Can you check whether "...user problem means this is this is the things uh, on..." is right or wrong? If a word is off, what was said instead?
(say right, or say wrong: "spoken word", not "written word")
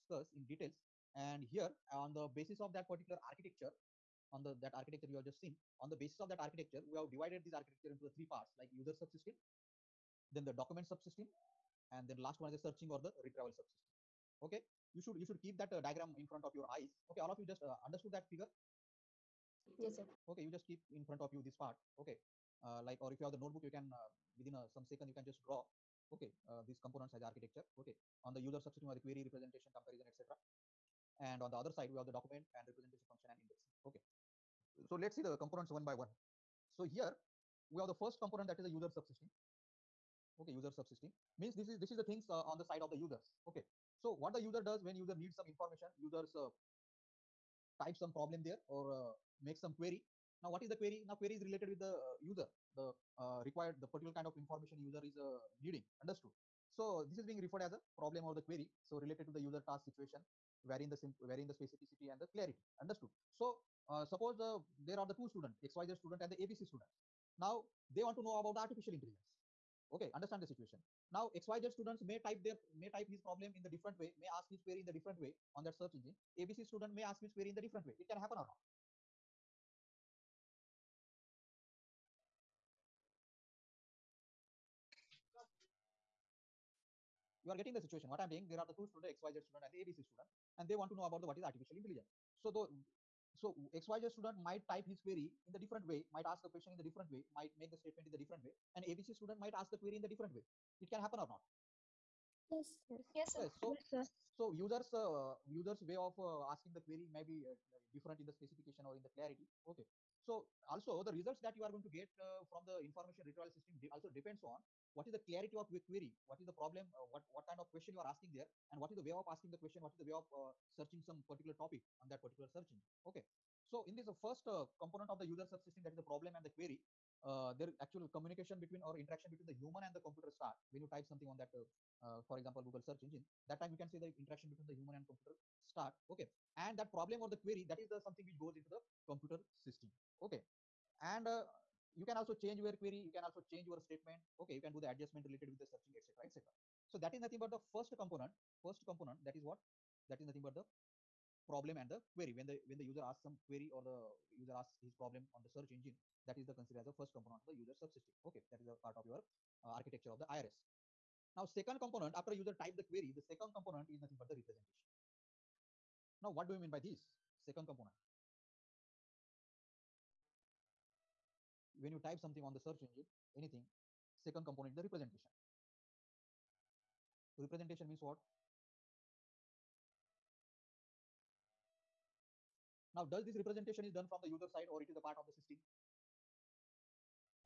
wrong: "subsystem", not "problem".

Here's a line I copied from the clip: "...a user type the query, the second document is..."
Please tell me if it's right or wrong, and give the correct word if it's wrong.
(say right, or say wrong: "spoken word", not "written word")
wrong: "component", not "document".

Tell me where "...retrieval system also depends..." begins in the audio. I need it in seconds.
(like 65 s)
113 s.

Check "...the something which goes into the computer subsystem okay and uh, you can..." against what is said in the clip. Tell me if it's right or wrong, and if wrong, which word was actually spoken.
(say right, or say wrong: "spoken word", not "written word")
wrong: "system", not "subsystem".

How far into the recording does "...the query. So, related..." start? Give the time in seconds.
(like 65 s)
58 s.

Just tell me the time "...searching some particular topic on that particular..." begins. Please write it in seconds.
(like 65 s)
120 s.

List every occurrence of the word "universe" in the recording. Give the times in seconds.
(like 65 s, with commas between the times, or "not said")
not said.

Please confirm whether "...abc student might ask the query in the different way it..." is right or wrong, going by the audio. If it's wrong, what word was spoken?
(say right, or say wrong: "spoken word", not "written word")
right.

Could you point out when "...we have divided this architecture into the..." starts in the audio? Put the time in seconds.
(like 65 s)
6 s.